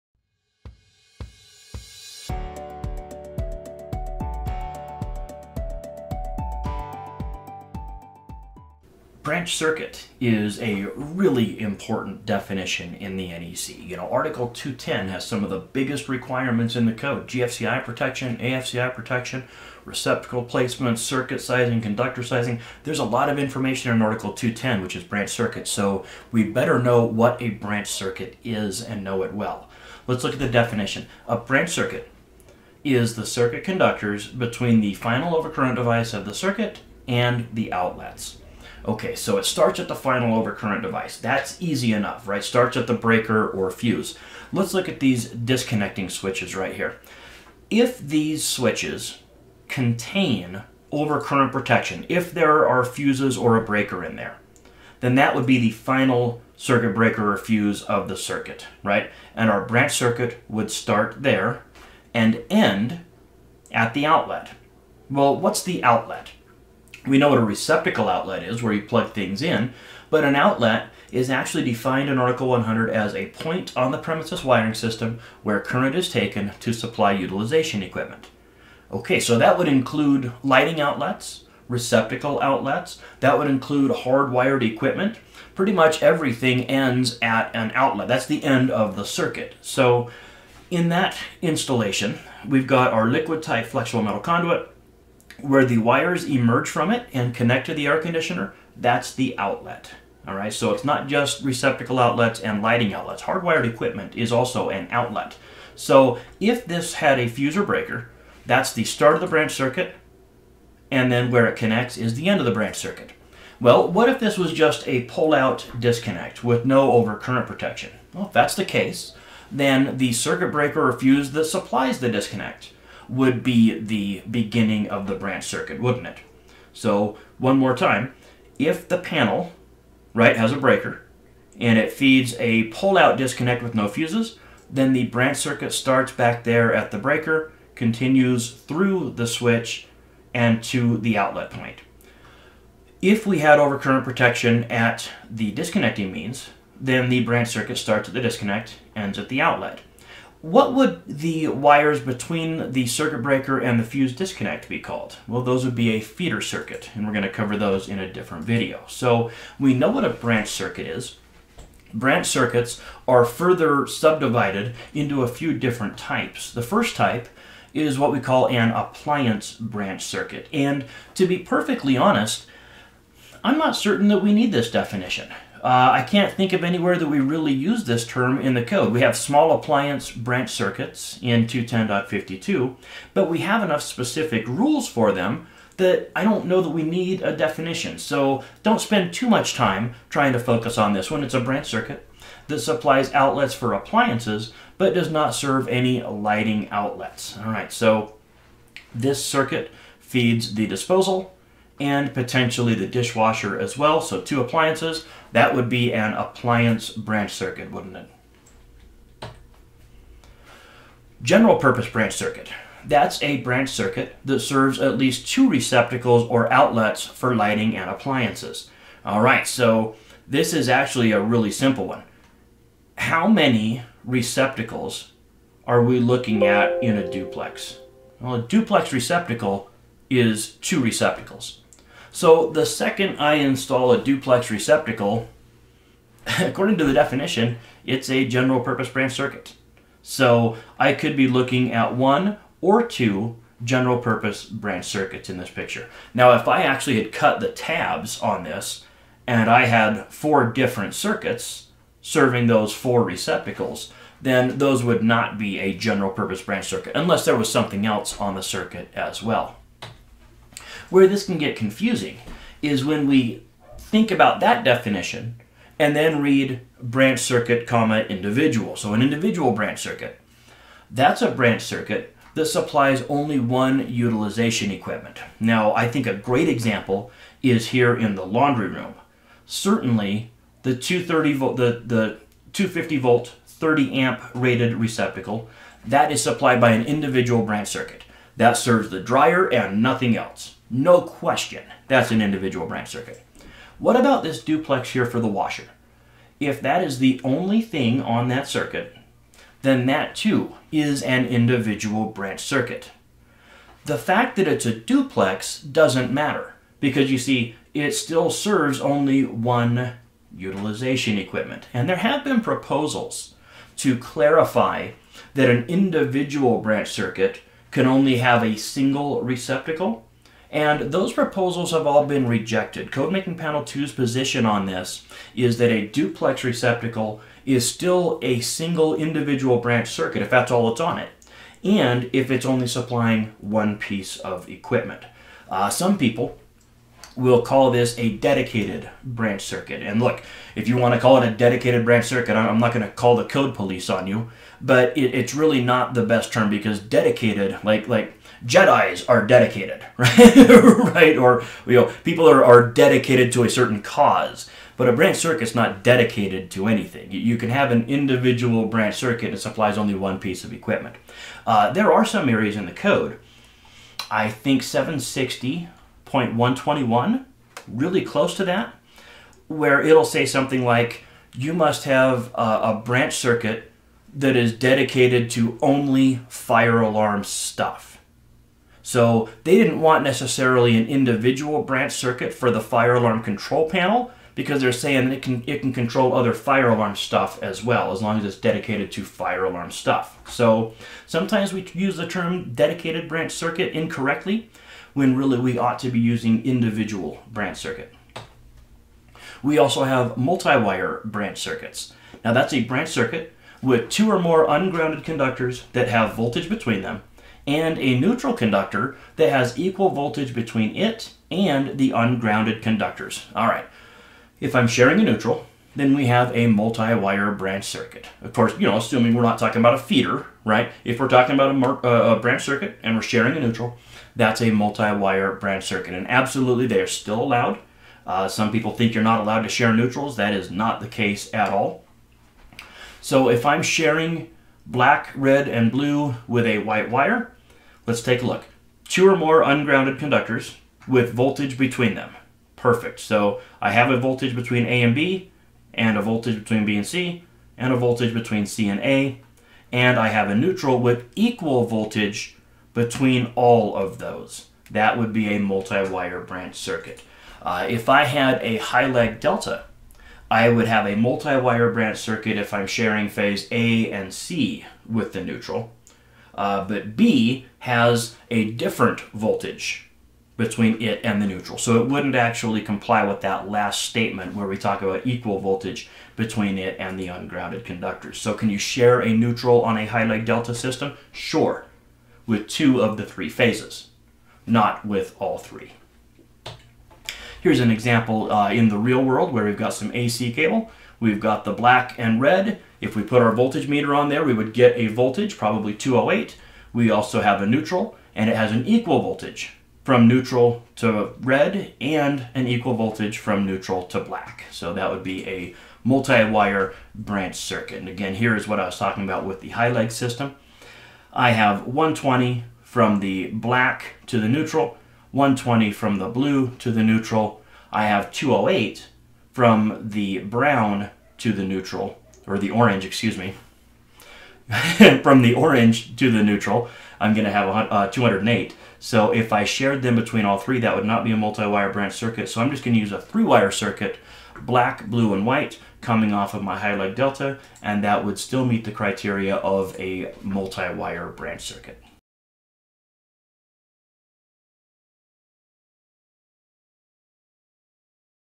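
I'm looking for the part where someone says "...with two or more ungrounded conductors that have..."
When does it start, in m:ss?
6:43.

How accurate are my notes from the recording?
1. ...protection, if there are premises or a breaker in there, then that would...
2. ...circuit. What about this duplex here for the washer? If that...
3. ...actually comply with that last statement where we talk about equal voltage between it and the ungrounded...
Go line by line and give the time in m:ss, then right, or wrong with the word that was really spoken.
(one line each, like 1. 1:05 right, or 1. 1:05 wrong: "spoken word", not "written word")
1. 0:51 wrong: "fuses", not "premises"
2. 4:52 right
3. 7:52 right.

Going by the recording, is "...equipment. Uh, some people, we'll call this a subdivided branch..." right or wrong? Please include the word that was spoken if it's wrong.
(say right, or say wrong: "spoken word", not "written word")
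wrong: "dedicated", not "subdivided".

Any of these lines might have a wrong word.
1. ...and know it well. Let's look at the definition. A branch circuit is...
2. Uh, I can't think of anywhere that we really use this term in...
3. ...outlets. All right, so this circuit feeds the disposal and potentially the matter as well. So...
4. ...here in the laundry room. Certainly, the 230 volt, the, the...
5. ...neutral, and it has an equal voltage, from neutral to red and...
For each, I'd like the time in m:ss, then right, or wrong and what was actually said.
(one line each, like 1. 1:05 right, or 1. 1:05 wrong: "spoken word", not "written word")
1. 0:28 right
2. 2:55 right
3. 3:16 wrong: "dishwasher", not "matter"
4. 4:37 right
5. 8:17 right.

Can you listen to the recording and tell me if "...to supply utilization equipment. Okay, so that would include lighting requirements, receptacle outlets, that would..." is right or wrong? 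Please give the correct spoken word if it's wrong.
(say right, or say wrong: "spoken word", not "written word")
wrong: "outlets", not "requirements".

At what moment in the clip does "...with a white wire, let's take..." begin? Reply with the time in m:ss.
7:16.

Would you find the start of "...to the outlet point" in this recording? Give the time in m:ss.
2:20.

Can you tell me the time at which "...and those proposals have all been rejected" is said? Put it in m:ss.
5:20.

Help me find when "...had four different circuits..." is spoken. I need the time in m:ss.
4:09.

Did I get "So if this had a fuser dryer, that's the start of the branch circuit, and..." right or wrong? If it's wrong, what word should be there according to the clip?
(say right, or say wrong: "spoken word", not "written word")
wrong: "breaker", not "dryer".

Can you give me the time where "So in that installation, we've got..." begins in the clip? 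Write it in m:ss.
1:29.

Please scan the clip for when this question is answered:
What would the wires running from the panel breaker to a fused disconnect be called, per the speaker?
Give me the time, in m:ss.
2:36.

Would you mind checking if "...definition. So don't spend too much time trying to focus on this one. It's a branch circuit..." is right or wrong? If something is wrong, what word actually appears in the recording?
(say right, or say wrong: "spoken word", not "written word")
right.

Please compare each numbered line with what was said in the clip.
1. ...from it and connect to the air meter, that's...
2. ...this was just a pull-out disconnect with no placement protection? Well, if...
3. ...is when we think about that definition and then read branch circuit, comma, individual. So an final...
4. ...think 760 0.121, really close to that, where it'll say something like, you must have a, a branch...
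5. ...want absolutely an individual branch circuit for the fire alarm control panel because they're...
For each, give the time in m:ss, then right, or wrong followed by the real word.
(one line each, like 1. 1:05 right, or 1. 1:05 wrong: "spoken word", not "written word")
1. 1:36 wrong: "conditioner", not "meter"
2. 1:54 wrong: "overcurrent", not "placement"
3. 4:22 wrong: "individual", not "final"
4. 6:04 right
5. 6:19 wrong: "necessarily", not "absolutely".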